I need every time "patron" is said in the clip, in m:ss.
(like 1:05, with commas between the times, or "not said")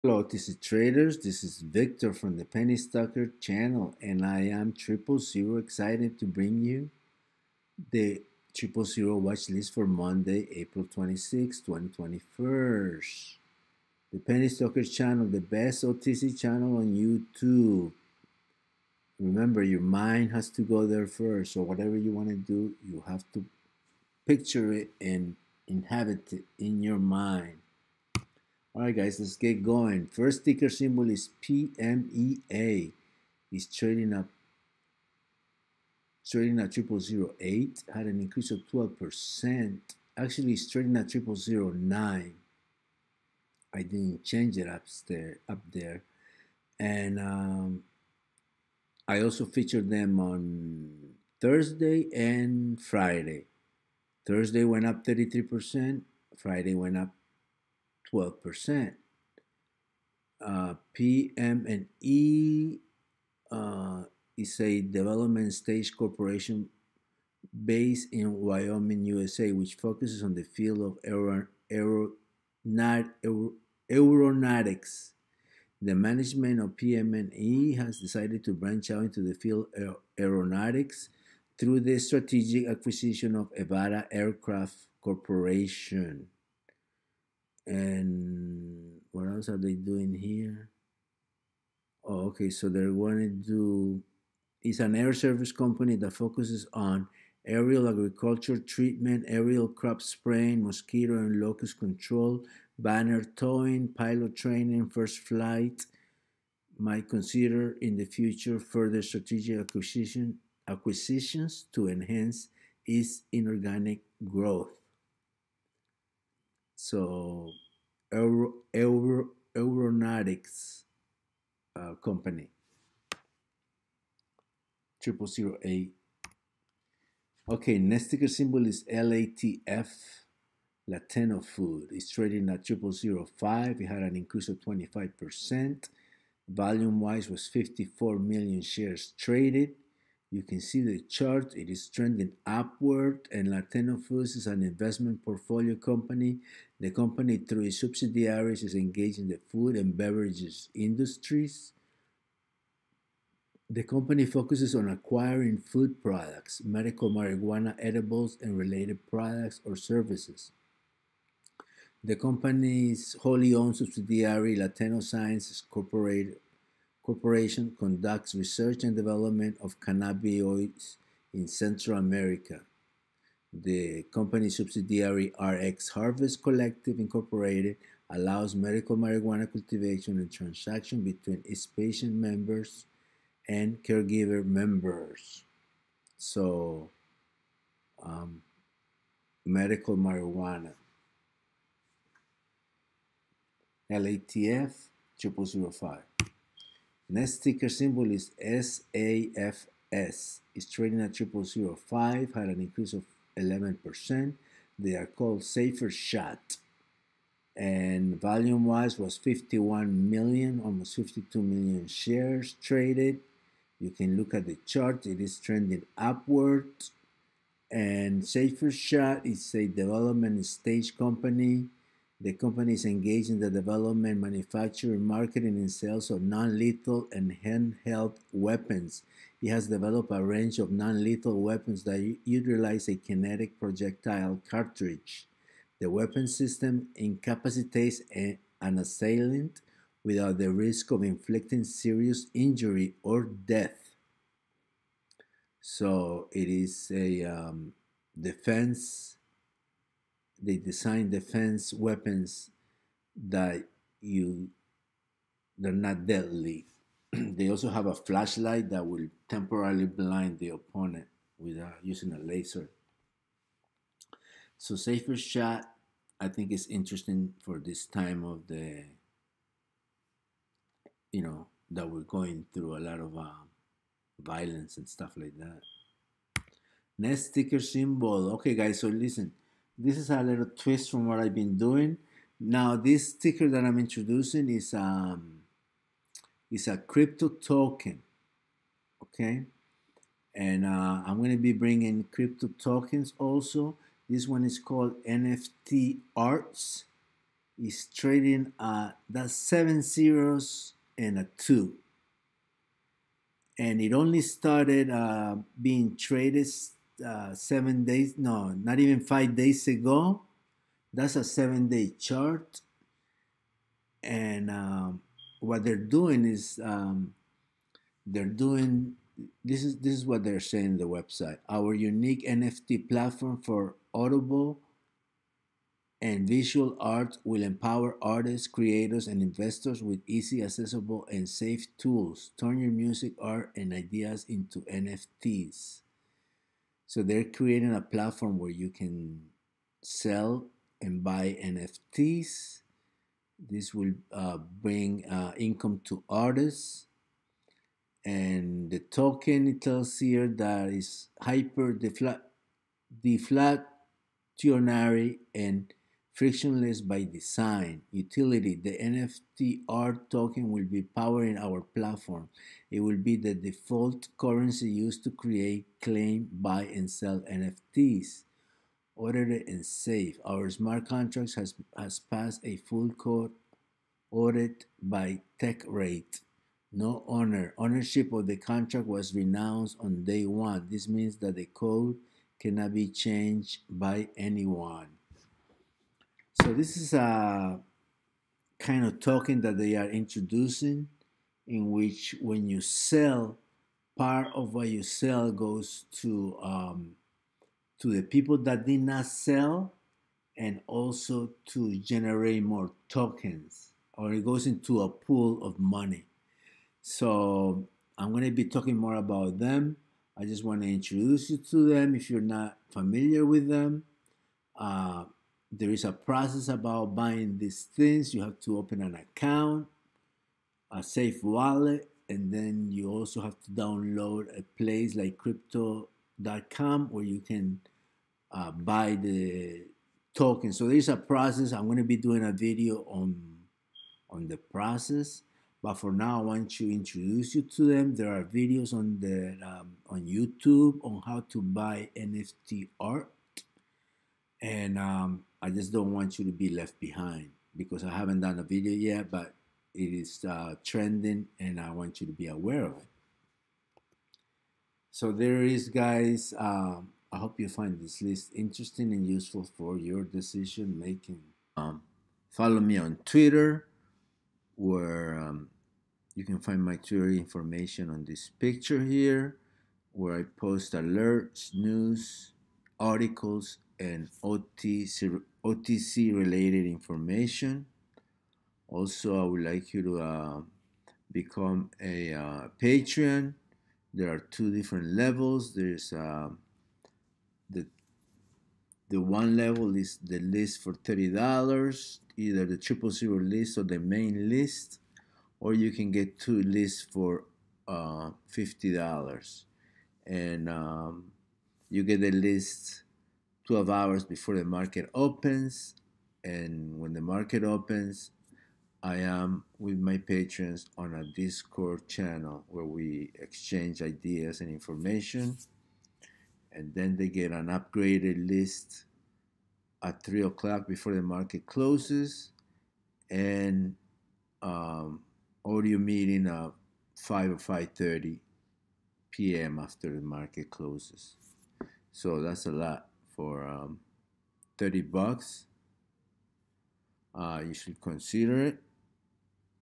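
8:02, 8:29.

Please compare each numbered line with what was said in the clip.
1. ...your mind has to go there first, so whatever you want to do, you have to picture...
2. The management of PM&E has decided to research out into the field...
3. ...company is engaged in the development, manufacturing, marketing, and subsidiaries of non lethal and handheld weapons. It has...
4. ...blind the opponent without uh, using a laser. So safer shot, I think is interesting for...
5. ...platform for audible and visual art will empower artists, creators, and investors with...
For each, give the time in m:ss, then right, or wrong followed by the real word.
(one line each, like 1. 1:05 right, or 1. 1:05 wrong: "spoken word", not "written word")
1. 0:19 right
2. 1:15 wrong: "branch", not "research"
3. 3:42 wrong: "sales", not "subsidiaries"
4. 4:19 right
5. 5:22 right.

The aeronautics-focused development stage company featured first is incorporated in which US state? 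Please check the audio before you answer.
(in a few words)
Wyoming.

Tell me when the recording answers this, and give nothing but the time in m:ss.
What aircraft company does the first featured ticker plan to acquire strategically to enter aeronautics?
1:23.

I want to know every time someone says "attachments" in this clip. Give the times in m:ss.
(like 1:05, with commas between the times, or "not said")
not said.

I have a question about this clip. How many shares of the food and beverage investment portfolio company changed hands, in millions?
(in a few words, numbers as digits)
54 million.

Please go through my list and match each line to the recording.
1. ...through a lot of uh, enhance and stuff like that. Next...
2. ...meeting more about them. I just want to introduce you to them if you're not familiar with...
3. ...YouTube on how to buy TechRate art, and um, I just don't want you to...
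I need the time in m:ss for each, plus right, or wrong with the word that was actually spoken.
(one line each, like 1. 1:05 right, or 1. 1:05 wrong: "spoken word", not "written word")
1. 4:32 wrong: "violence", not "enhance"
2. 6:48 wrong: "talking", not "meeting"
3. 7:20 wrong: "NFT", not "TechRate".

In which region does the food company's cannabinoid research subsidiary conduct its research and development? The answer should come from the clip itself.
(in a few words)
Central America.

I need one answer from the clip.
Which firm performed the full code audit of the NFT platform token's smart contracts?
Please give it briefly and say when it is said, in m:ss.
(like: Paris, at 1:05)
TechRate, at 6:15.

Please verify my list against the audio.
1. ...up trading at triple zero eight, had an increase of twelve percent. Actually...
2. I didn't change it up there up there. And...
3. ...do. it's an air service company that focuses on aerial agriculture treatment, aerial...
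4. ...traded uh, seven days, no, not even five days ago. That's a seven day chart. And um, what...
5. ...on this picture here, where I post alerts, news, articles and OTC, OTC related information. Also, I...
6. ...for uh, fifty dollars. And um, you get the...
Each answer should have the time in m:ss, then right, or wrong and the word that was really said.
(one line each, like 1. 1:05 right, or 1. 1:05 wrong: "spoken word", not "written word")
1. 0:34 right
2. 0:43 right
3. 1:33 right
4. 5:05 right
5. 7:47 right
6. 8:16 right.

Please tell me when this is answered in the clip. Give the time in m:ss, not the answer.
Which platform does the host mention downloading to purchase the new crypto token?
7:05.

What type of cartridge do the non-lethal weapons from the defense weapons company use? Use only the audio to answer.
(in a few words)
kinetic projectile cartridge.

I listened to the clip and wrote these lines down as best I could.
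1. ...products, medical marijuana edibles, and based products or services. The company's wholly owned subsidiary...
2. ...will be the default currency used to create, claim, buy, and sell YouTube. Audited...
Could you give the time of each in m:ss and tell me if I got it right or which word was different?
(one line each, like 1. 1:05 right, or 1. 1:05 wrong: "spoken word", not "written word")
1. 2:36 wrong: "related", not "based"
2. 6:02 wrong: "NFTs", not "YouTube".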